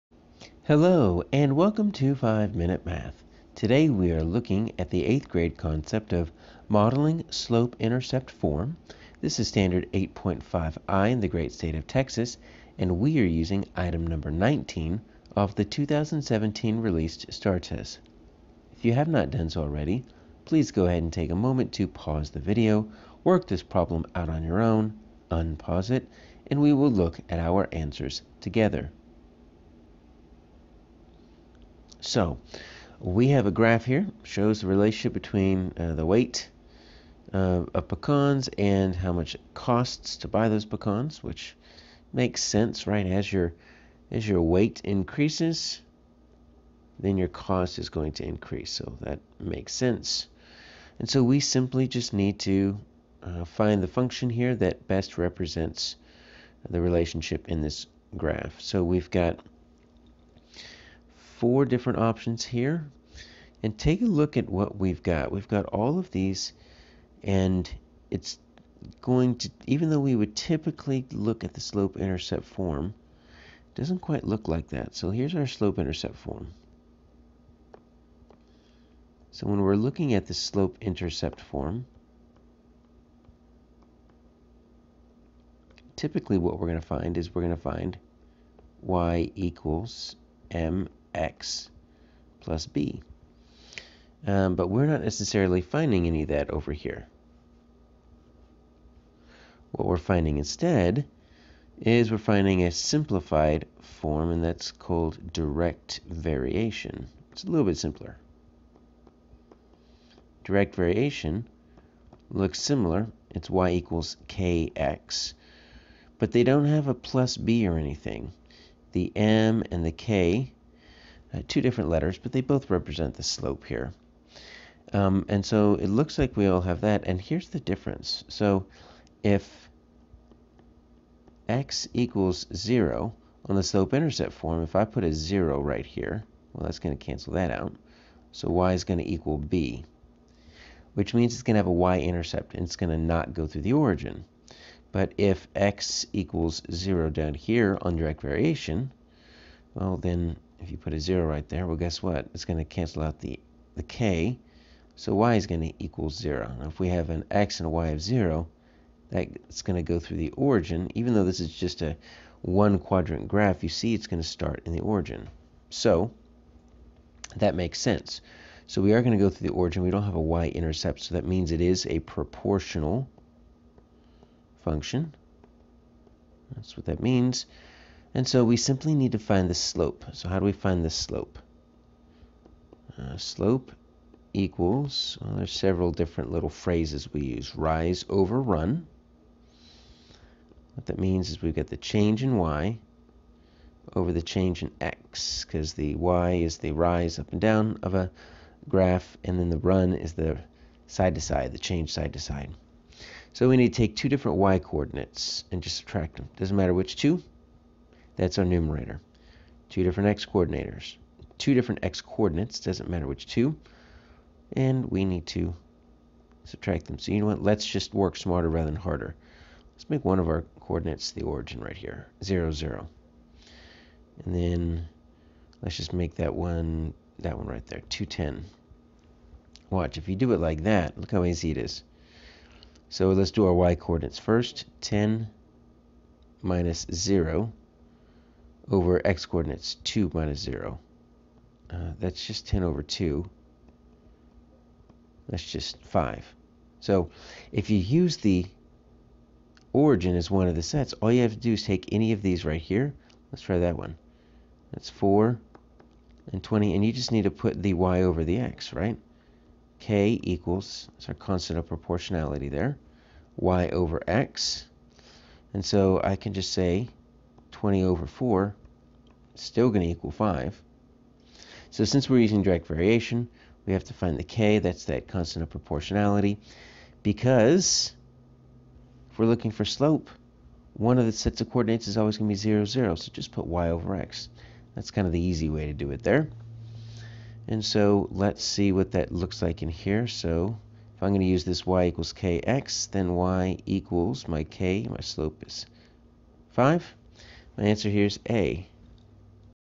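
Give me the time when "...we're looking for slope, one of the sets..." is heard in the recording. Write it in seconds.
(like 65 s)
279 s.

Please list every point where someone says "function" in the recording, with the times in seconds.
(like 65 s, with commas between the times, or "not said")
53 s, 174 s.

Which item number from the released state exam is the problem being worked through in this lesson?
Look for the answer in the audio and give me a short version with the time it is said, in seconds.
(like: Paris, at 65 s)
19, at 13 s.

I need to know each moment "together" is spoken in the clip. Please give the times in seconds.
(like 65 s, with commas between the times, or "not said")
28 s.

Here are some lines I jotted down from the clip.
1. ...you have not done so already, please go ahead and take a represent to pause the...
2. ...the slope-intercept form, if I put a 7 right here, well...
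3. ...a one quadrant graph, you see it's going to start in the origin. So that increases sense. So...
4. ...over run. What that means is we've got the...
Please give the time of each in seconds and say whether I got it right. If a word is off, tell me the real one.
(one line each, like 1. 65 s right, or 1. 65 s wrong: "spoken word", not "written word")
1. 18 s wrong: "moment", not "represent"
2. 133 s wrong: "0", not "7"
3. 161 s wrong: "makes", not "increases"
4. 188 s right.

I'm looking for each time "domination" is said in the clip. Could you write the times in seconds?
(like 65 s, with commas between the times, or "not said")
not said.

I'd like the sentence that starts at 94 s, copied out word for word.
Um, but we're not necessarily finding any of that over here.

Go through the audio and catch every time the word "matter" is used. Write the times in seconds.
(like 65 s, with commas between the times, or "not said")
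206 s, 212 s.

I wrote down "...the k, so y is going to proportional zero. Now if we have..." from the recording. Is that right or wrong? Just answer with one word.
wrong.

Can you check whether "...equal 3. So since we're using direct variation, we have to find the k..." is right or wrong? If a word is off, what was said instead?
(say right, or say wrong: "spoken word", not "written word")
wrong: "5", not "3".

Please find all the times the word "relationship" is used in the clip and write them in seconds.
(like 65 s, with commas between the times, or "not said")
34 s, 56 s.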